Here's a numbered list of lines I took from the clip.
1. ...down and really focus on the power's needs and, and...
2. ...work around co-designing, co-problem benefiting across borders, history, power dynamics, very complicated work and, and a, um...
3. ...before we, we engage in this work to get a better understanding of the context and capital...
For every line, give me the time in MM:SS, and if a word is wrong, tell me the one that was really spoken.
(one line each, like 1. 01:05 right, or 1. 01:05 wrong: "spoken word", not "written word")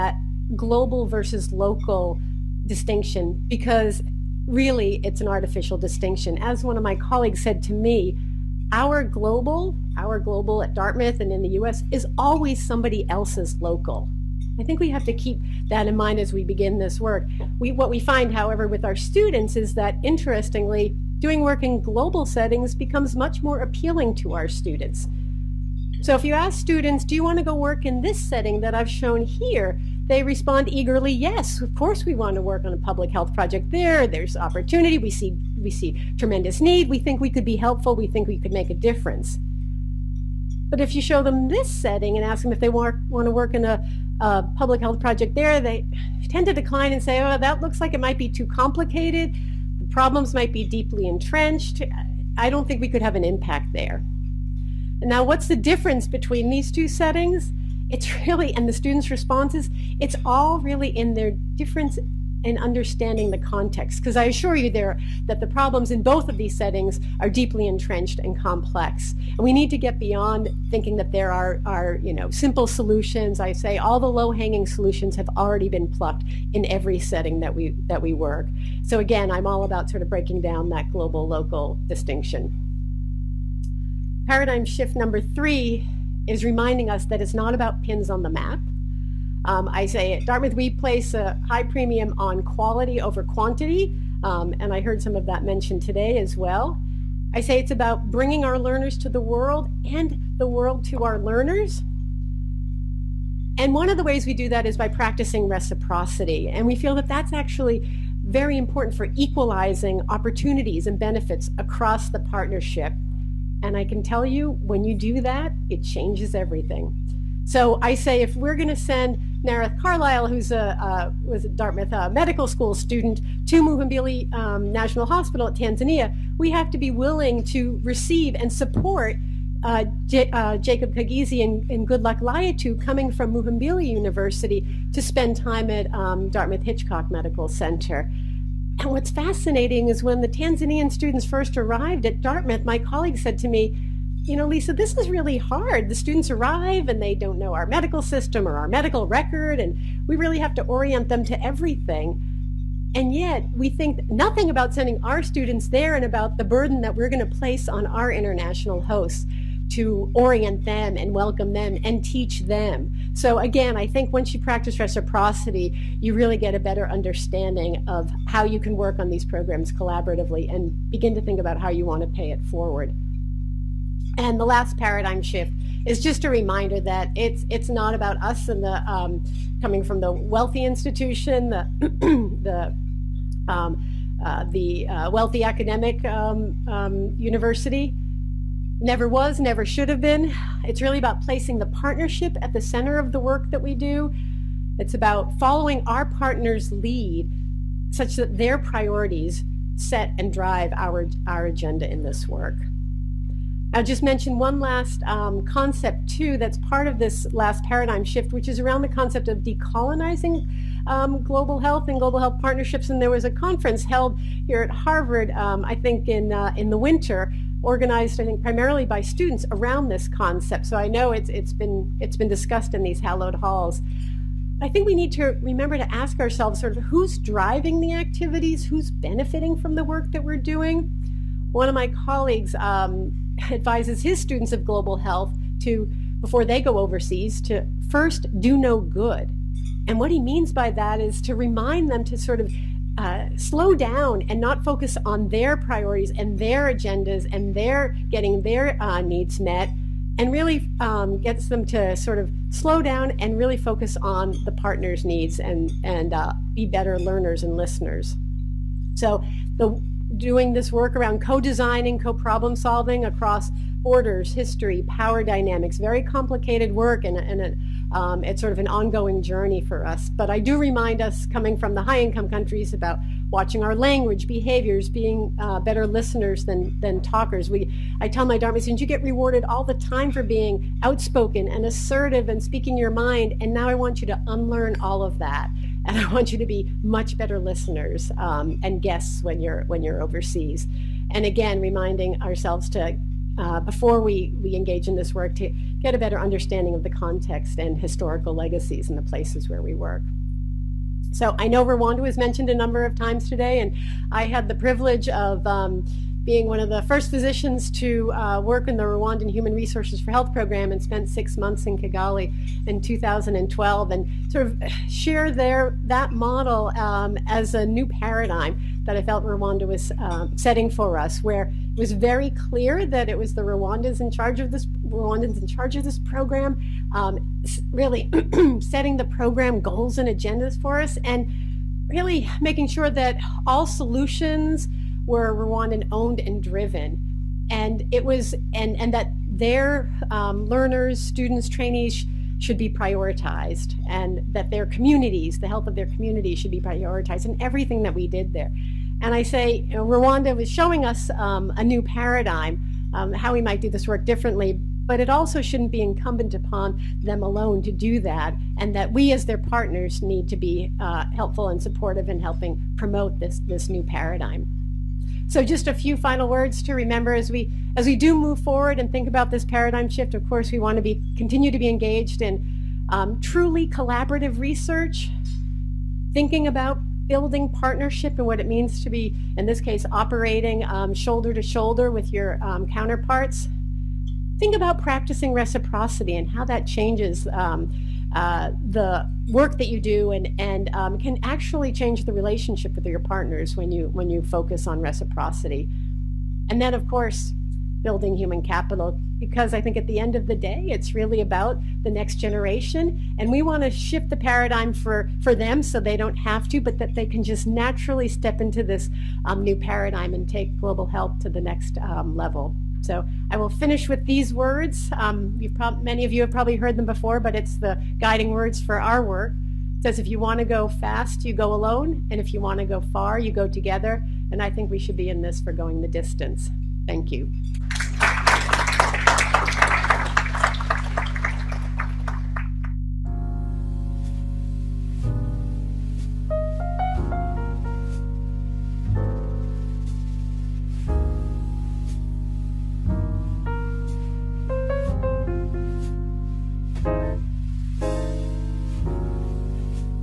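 1. 04:12 wrong: "partner", not "power"
2. 04:20 wrong: "solving", not "benefiting"
3. 04:53 wrong: "historical", not "capital".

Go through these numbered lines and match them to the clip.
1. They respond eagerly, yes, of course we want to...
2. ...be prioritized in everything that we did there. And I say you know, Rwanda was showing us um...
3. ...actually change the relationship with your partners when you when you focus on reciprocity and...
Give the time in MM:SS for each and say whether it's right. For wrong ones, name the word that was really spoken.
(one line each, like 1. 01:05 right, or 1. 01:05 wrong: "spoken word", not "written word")
1. 00:30 right
2. 05:46 right
3. 06:31 right.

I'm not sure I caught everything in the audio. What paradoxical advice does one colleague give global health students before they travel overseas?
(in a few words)
first do no good.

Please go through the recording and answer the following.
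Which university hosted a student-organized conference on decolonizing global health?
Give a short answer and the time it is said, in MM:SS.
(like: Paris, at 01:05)
Harvard, at 03:34.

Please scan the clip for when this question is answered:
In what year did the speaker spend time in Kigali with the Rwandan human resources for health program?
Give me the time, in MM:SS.
05:12.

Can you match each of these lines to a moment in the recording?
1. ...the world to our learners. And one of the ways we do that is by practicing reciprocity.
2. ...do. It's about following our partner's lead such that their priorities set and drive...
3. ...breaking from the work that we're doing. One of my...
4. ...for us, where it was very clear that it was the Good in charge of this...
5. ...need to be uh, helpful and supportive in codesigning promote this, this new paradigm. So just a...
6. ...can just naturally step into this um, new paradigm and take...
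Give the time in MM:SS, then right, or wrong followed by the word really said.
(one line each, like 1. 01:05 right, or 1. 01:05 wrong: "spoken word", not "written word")
1. 01:40 right
2. 03:13 right
3. 03:48 wrong: "benefiting", not "breaking"
4. 05:20 wrong: "Rwandans", not "Good"
5. 06:00 wrong: "helping", not "codesigning"
6. 06:47 right.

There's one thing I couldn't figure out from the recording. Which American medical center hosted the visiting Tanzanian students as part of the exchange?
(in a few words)
Dartmouth Hitchcock Medical Center.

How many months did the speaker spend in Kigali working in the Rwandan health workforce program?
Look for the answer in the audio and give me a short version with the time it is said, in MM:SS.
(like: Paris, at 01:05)
6, at 05:11.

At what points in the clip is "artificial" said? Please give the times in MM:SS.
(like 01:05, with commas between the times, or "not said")
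00:05.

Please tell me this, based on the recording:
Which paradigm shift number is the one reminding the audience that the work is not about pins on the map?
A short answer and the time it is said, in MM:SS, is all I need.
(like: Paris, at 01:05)
3, at 01:25.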